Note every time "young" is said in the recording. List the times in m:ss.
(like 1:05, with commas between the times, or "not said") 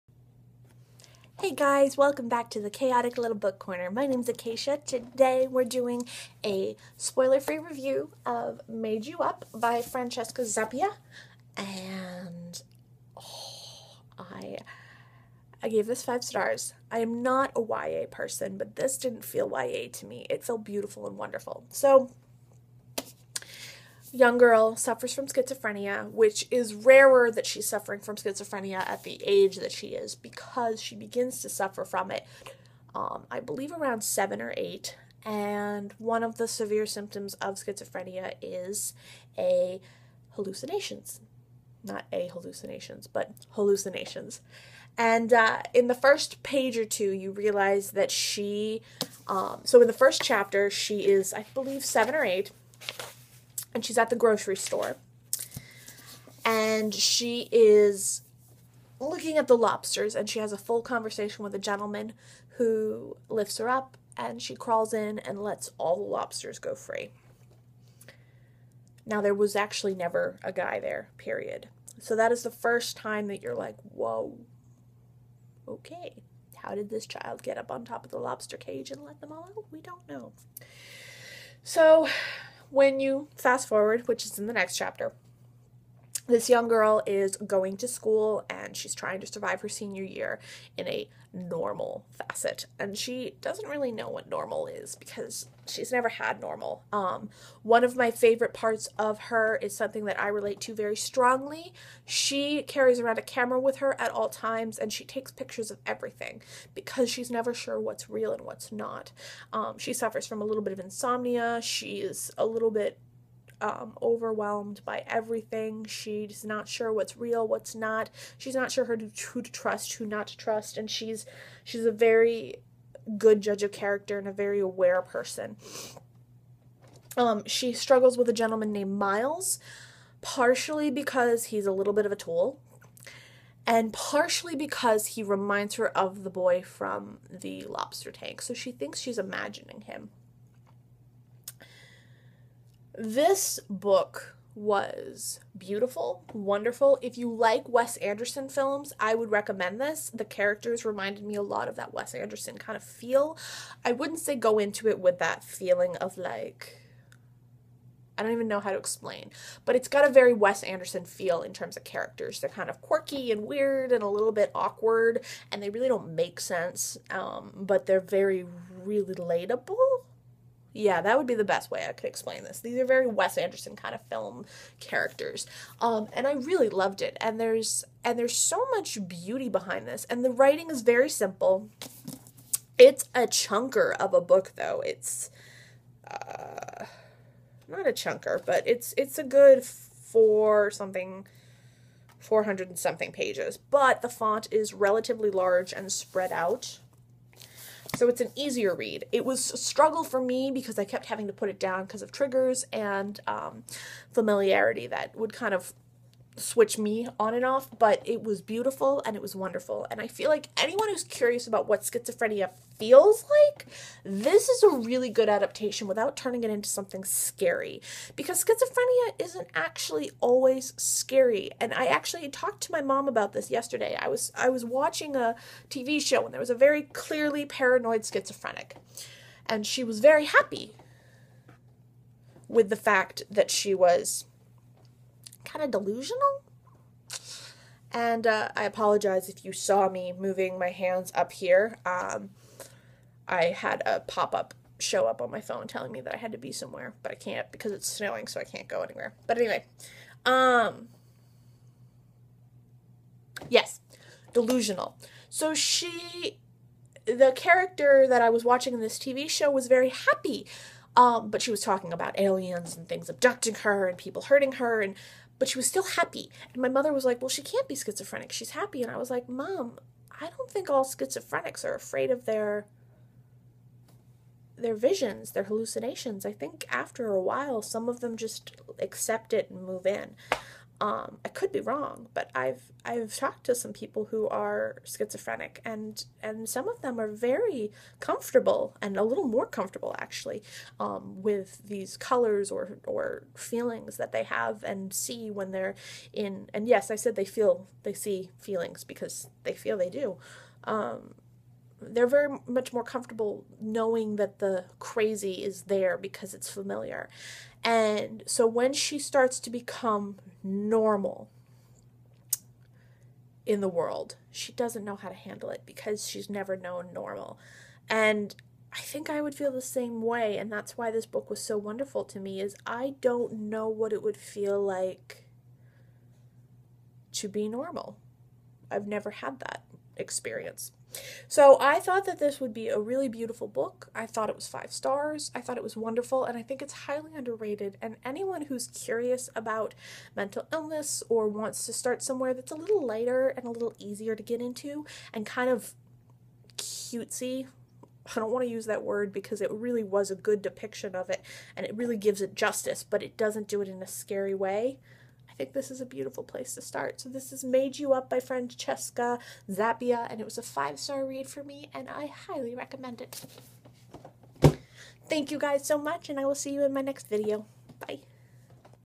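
0:24, 1:26.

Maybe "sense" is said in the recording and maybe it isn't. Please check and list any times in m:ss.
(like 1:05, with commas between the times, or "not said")
2:46.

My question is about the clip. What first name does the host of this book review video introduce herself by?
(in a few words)
Acacia.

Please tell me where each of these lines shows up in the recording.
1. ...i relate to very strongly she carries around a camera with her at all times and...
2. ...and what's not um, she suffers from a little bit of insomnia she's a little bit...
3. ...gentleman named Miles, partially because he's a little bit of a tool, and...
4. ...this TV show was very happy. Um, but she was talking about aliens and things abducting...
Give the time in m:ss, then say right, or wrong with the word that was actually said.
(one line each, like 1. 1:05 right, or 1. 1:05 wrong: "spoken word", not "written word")
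1. 1:40 right
2. 1:48 right
3. 2:08 right
4. 4:18 right.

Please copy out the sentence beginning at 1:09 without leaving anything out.
Now, there was actually never a guy there, period.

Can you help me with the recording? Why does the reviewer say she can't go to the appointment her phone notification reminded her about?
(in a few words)
It's snowing.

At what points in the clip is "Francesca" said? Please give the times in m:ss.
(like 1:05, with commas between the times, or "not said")
0:09, 5:58.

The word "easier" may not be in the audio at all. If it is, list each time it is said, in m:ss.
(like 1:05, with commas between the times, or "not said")
3:18, 5:43.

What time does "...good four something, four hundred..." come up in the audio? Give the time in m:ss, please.
3:09.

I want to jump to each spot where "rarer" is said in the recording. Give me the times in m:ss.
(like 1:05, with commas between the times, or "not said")
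0:26.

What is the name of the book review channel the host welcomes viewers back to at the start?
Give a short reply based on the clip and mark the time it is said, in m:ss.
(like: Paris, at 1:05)
Chaotic Little Book Corner, at 0:02.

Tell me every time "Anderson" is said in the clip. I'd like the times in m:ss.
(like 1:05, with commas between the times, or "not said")
2:27, 2:32, 2:40, 2:53.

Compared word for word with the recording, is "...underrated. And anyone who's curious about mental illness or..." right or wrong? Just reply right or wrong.
right.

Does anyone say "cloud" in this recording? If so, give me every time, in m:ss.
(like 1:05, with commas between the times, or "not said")
not said.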